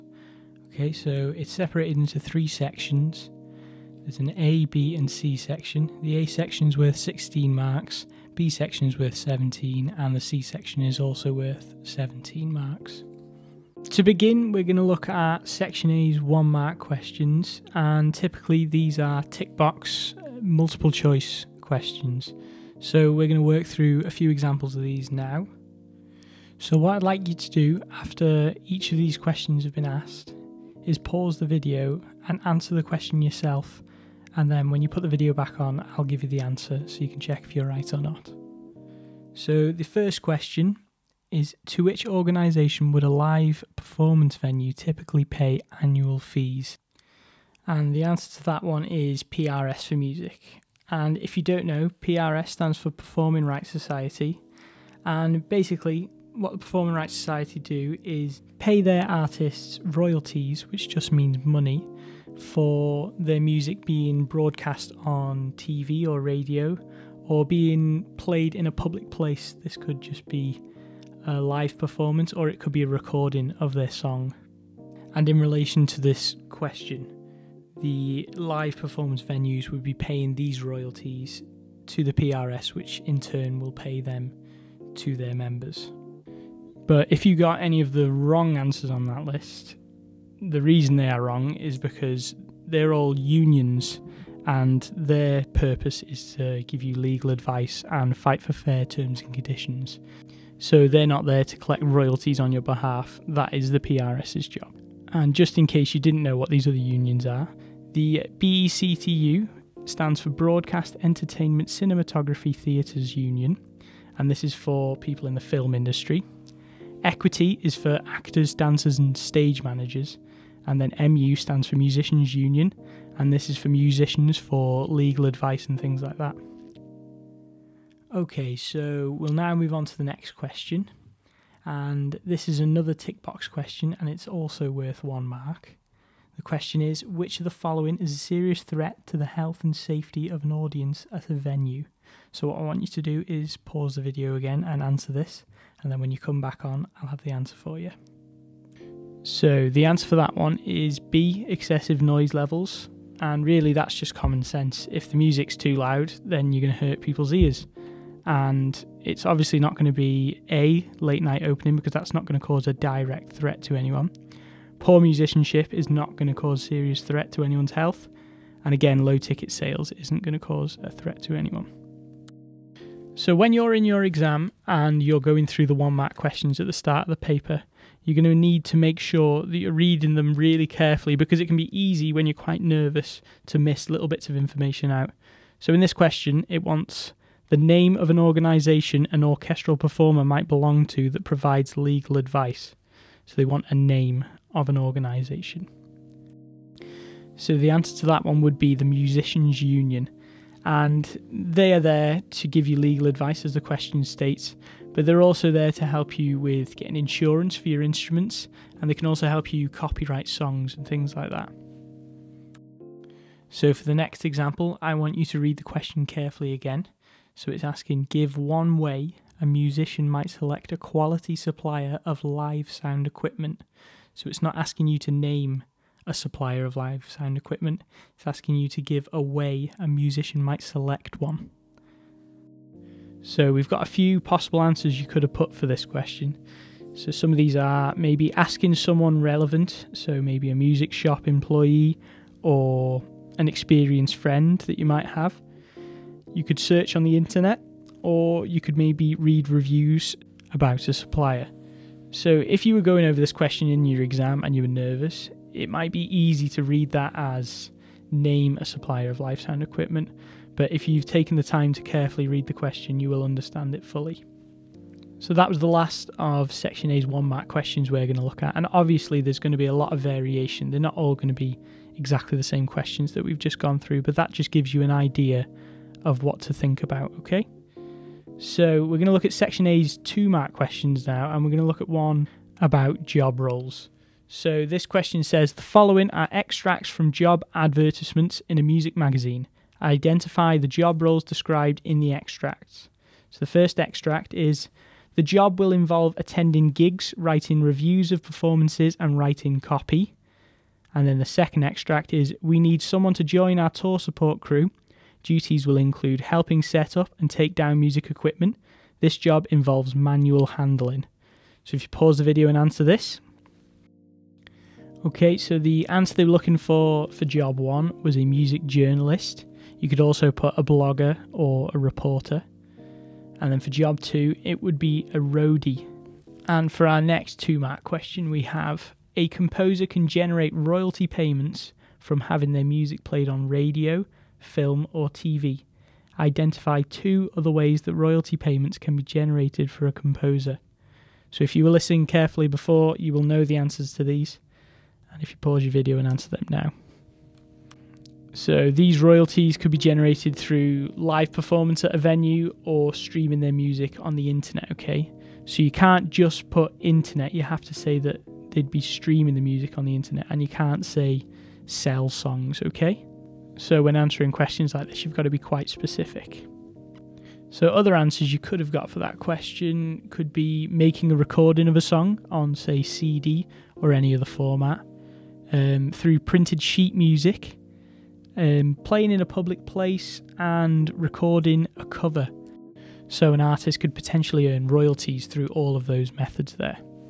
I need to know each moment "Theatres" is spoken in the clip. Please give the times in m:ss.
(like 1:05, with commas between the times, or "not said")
1:52.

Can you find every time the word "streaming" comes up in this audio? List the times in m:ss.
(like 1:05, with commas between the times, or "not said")
5:52, 5:58.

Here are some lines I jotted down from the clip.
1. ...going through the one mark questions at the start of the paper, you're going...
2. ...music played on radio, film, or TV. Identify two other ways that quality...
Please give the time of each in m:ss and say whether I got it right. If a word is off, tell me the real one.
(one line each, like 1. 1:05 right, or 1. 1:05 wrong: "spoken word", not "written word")
1. 2:55 right
2. 5:32 wrong: "royalty", not "quality".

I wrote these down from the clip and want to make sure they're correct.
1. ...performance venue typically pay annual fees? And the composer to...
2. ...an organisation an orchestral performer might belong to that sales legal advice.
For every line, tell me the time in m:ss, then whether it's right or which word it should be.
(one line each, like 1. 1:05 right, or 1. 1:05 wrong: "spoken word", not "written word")
1. 0:43 wrong: "answer", not "composer"
2. 3:08 wrong: "provides", not "sales".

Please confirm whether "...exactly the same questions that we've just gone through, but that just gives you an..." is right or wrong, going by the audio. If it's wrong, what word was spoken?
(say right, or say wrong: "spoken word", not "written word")
right.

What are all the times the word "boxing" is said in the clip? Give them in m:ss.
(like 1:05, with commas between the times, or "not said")
not said.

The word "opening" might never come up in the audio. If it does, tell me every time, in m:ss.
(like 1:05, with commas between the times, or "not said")
2:41.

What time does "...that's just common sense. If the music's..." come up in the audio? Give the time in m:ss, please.
2:33.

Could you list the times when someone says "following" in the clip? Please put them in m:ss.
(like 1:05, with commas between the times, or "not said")
2:17, 4:45.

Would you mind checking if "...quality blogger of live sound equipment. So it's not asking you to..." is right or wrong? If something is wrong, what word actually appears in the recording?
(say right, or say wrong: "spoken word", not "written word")
wrong: "supplier", not "blogger".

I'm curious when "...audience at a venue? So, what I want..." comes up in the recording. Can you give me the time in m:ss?
2:20.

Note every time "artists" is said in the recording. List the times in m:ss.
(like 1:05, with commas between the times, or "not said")
0:59, 6:23.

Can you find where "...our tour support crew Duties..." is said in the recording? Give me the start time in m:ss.
5:03.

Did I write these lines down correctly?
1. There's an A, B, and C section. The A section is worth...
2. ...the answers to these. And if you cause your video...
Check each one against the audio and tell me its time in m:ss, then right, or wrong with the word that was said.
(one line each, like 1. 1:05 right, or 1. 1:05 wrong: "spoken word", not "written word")
1. 0:04 right
2. 5:43 wrong: "pause", not "cause".